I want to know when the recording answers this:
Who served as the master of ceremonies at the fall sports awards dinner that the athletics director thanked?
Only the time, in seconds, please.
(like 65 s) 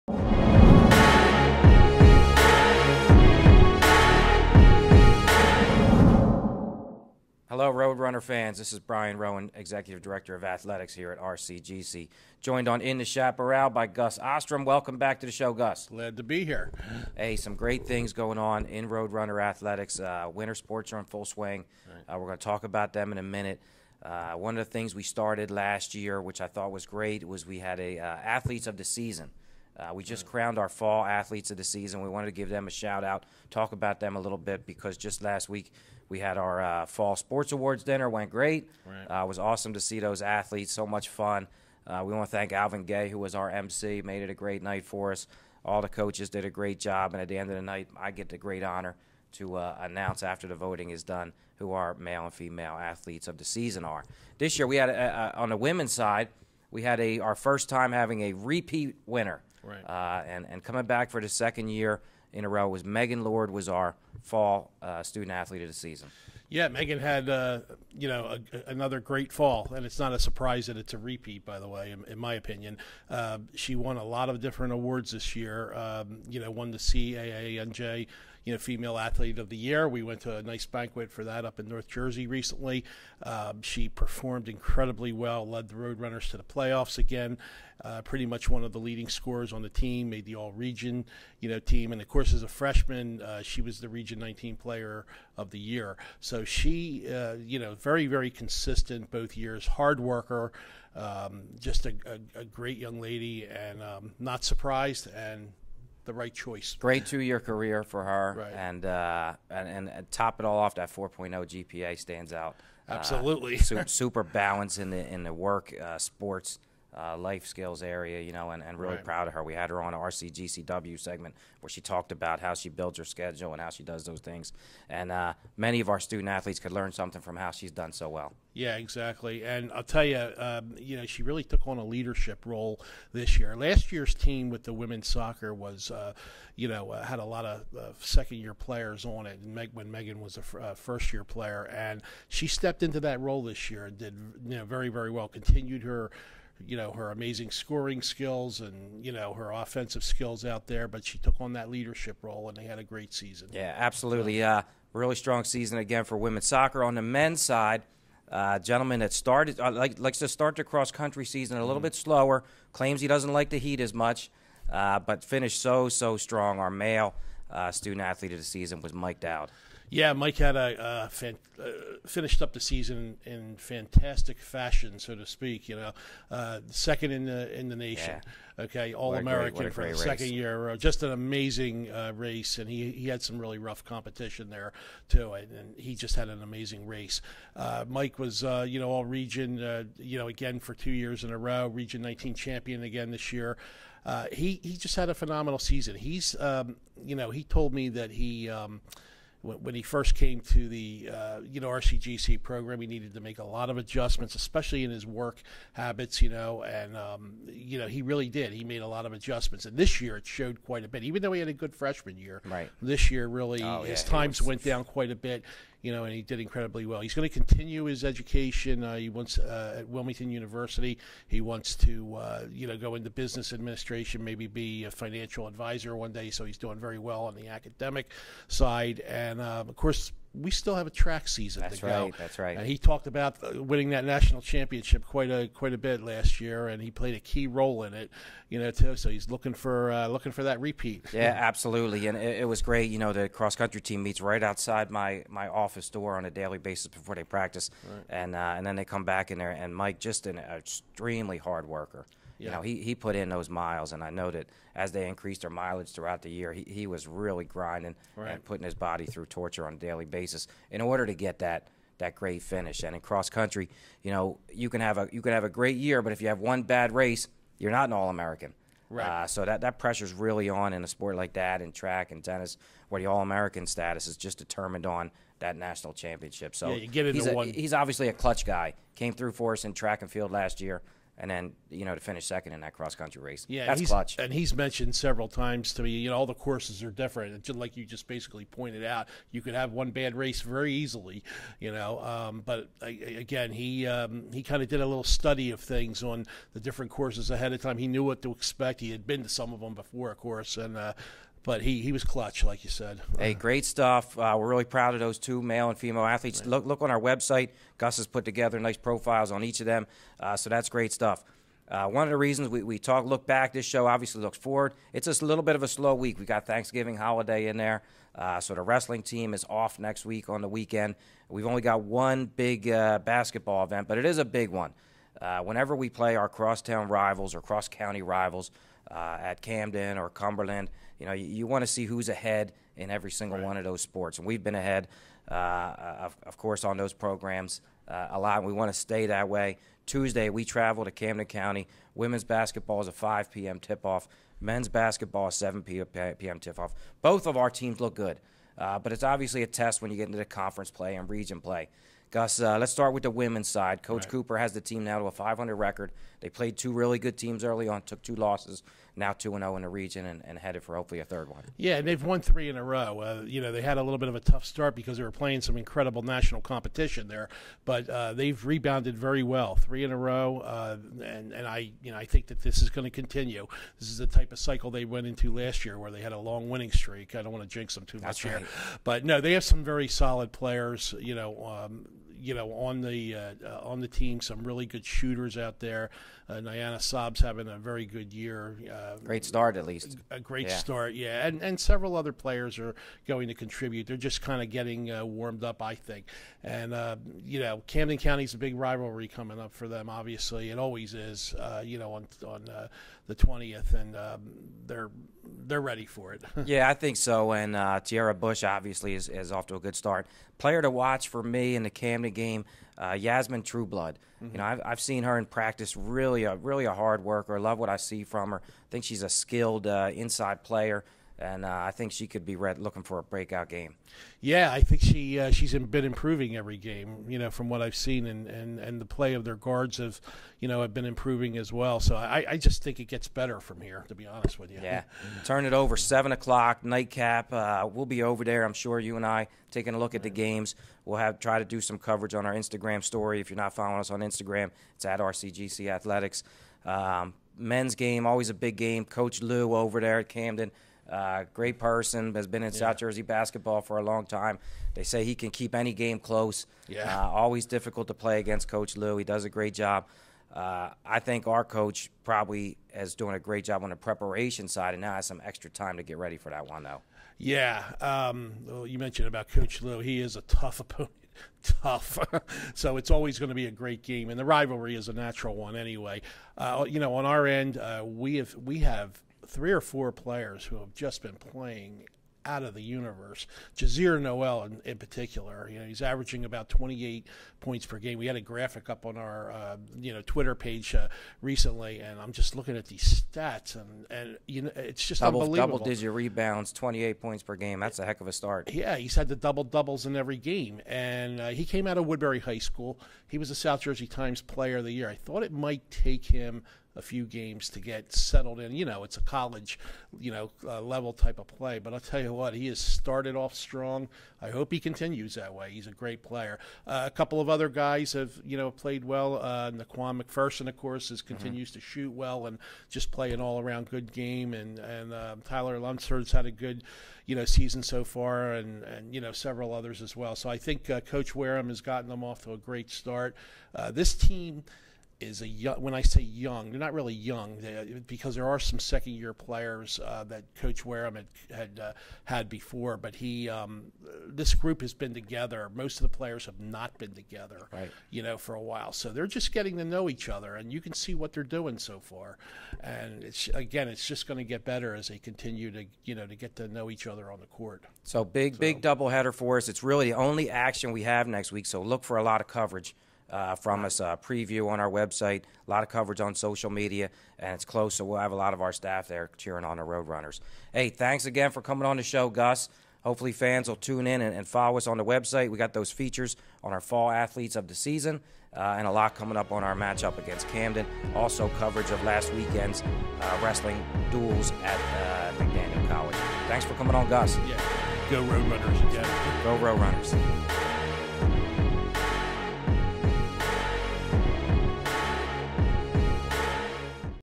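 42 s.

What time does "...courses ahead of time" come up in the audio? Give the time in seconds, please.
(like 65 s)
296 s.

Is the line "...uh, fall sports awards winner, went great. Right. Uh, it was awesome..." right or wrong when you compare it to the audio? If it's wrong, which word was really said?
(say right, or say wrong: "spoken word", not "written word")
wrong: "dinner", not "winner".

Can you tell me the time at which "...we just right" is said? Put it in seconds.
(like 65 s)
29 s.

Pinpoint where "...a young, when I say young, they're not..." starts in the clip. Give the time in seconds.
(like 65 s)
535 s.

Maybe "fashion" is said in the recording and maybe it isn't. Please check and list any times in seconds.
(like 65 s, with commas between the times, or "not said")
174 s.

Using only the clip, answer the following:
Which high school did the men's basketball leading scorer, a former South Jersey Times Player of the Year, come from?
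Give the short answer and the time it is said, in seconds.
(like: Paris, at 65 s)
Woodbury High School, at 501 s.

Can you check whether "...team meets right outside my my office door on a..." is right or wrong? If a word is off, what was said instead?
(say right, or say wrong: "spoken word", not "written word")
right.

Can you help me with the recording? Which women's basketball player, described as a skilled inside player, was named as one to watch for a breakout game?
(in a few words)
Yasmin Trueblood.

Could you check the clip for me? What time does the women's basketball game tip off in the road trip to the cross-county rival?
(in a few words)
5 p.m.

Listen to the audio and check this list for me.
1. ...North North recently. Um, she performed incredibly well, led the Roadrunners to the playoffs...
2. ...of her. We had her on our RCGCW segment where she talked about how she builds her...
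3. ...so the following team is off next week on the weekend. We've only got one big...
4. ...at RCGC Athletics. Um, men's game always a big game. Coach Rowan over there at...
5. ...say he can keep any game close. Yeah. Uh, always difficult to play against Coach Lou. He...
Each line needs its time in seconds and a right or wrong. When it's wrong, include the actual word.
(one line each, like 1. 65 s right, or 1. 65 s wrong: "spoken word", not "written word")
1. 81 s wrong: "Jersey", not "North"
2. 119 s right
3. 318 s wrong: "wrestling", not "following"
4. 444 s wrong: "Lou", not "Rowan"
5. 454 s right.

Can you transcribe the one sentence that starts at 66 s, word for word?
Yeah, Megan had uh, you know a, another great fall, and it's not a surprise that it's a repeat.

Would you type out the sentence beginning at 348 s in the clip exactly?
Uh, but it's obviously a test when you get into the conference play and region play.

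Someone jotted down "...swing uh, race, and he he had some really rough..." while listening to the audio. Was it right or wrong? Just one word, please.
wrong.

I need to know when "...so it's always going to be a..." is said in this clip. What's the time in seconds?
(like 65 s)
472 s.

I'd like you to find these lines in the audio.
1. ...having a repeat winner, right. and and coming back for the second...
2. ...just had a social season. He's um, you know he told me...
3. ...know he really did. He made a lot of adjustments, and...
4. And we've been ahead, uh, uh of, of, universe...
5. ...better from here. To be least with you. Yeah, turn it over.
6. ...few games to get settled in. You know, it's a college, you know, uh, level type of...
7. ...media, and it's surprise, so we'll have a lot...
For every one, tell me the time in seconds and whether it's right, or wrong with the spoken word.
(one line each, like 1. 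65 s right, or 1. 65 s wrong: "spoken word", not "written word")
1. 57 s right
2. 194 s wrong: "phenomenal", not "social"
3. 207 s right
4. 334 s wrong: "course", not "universe"
5. 433 s wrong: "honest", not "least"
6. 506 s right
7. 566 s wrong: "close", not "surprise".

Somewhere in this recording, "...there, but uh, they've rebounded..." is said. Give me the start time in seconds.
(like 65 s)
367 s.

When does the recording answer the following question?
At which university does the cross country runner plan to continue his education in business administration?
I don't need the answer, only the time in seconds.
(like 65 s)
219 s.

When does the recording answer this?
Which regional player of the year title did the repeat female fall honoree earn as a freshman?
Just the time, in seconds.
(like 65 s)
93 s.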